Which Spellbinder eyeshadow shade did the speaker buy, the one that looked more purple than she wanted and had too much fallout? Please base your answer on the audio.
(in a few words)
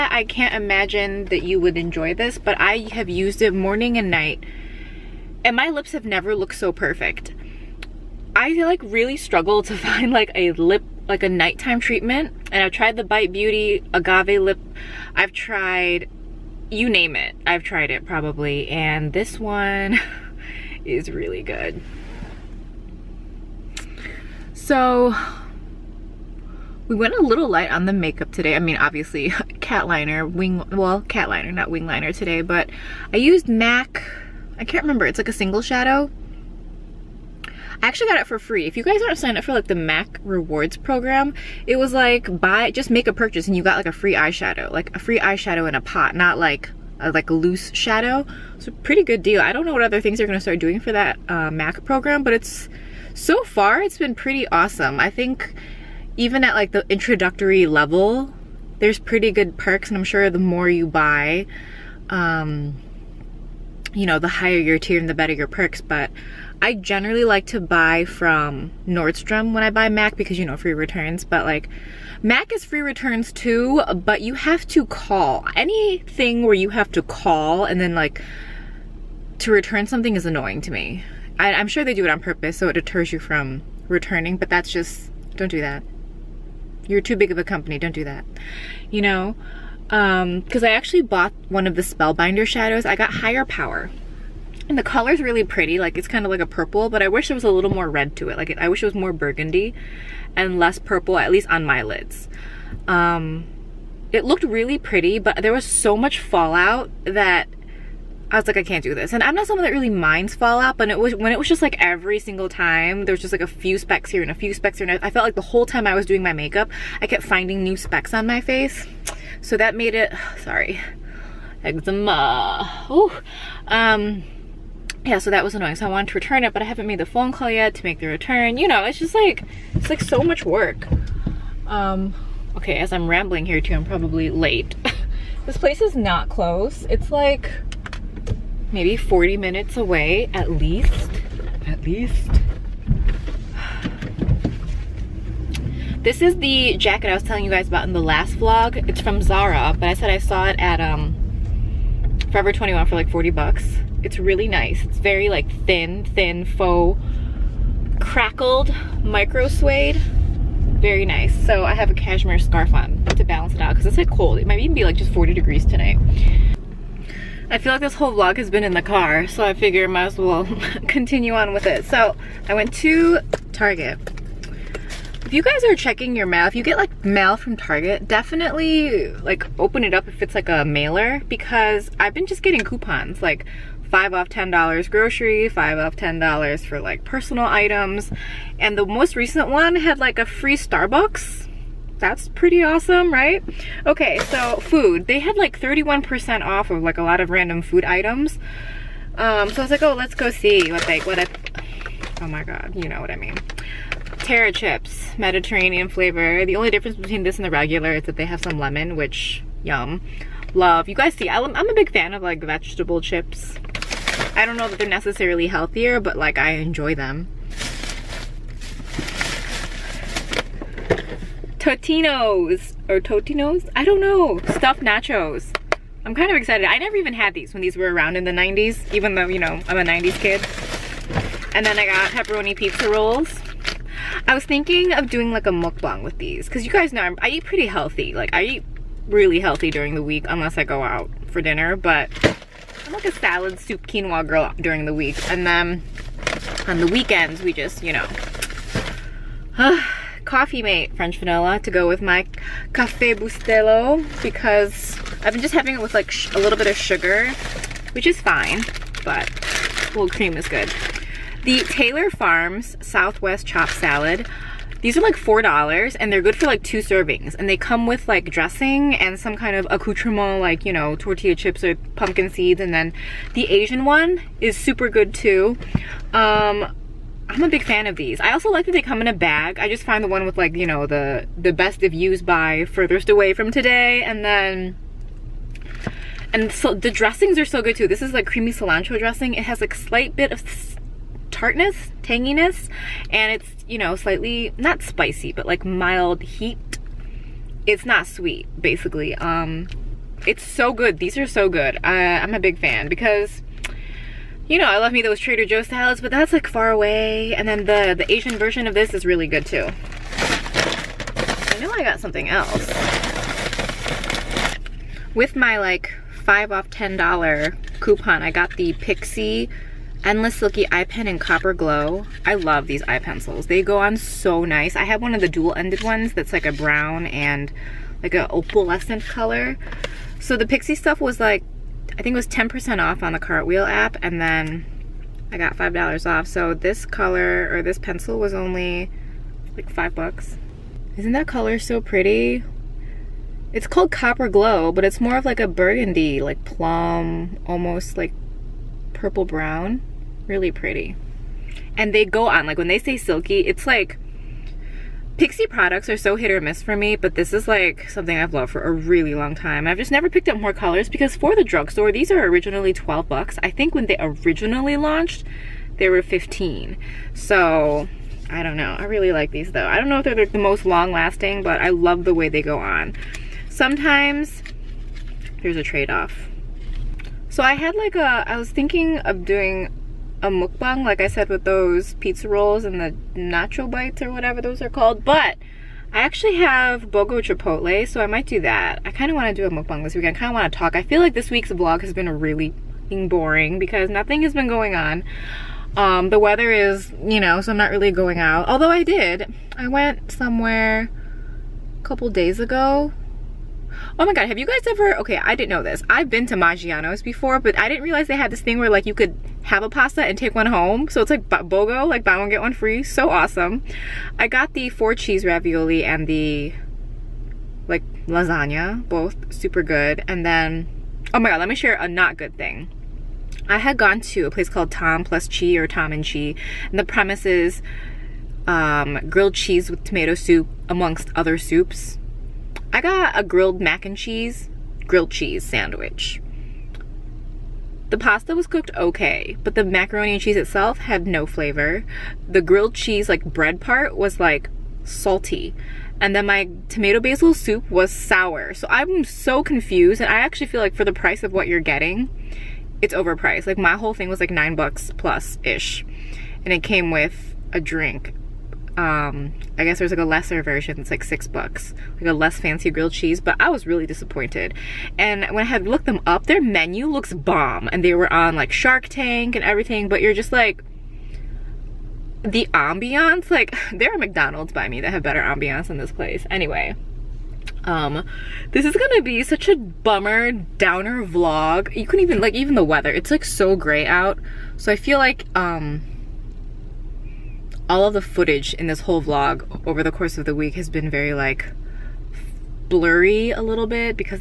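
Higher Power.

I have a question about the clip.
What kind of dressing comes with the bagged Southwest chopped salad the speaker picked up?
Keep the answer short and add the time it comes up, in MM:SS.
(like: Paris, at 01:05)
Creamy cilantro, at 04:48.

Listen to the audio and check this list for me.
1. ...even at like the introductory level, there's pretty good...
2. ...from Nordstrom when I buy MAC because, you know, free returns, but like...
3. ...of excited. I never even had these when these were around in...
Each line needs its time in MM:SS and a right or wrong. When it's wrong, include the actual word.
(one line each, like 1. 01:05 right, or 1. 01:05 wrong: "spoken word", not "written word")
1. 00:56 right
2. 01:08 right
3. 03:46 right.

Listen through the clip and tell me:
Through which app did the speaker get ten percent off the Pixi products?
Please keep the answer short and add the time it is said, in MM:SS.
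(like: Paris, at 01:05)
Cartwheel, at 05:33.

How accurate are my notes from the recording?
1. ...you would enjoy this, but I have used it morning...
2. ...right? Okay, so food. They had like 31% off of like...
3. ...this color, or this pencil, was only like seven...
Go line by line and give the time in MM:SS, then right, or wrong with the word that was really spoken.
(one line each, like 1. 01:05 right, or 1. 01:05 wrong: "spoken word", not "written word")
1. 00:01 right
2. 03:13 right
3. 05:36 wrong: "five", not "seven".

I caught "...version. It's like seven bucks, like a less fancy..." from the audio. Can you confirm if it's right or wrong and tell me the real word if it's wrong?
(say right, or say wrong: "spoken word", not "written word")
wrong: "six", not "seven".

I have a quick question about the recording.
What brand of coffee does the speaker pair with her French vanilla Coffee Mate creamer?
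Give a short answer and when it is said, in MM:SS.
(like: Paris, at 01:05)
Cafe Bustelo, at 04:12.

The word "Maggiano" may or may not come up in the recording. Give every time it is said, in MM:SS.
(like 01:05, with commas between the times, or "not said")
06:46.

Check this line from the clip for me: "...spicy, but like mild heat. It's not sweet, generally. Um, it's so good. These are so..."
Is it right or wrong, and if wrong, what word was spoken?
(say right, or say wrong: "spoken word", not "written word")
wrong: "basically", not "generally".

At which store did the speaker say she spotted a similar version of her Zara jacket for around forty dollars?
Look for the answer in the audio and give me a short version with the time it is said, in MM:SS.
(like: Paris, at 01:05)
Forever 21, at 02:32.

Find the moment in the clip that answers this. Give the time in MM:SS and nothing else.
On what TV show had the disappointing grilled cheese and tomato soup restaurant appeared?
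07:48.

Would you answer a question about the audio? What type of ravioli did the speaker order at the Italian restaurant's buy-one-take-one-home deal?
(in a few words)
Four cheese ravioli.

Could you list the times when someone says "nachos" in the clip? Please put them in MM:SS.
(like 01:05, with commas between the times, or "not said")
03:44, 06:23.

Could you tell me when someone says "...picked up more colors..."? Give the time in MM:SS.
06:00.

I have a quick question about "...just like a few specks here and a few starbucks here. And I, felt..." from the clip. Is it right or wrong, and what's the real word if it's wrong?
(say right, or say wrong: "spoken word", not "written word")
wrong: "specks", not "starbucks".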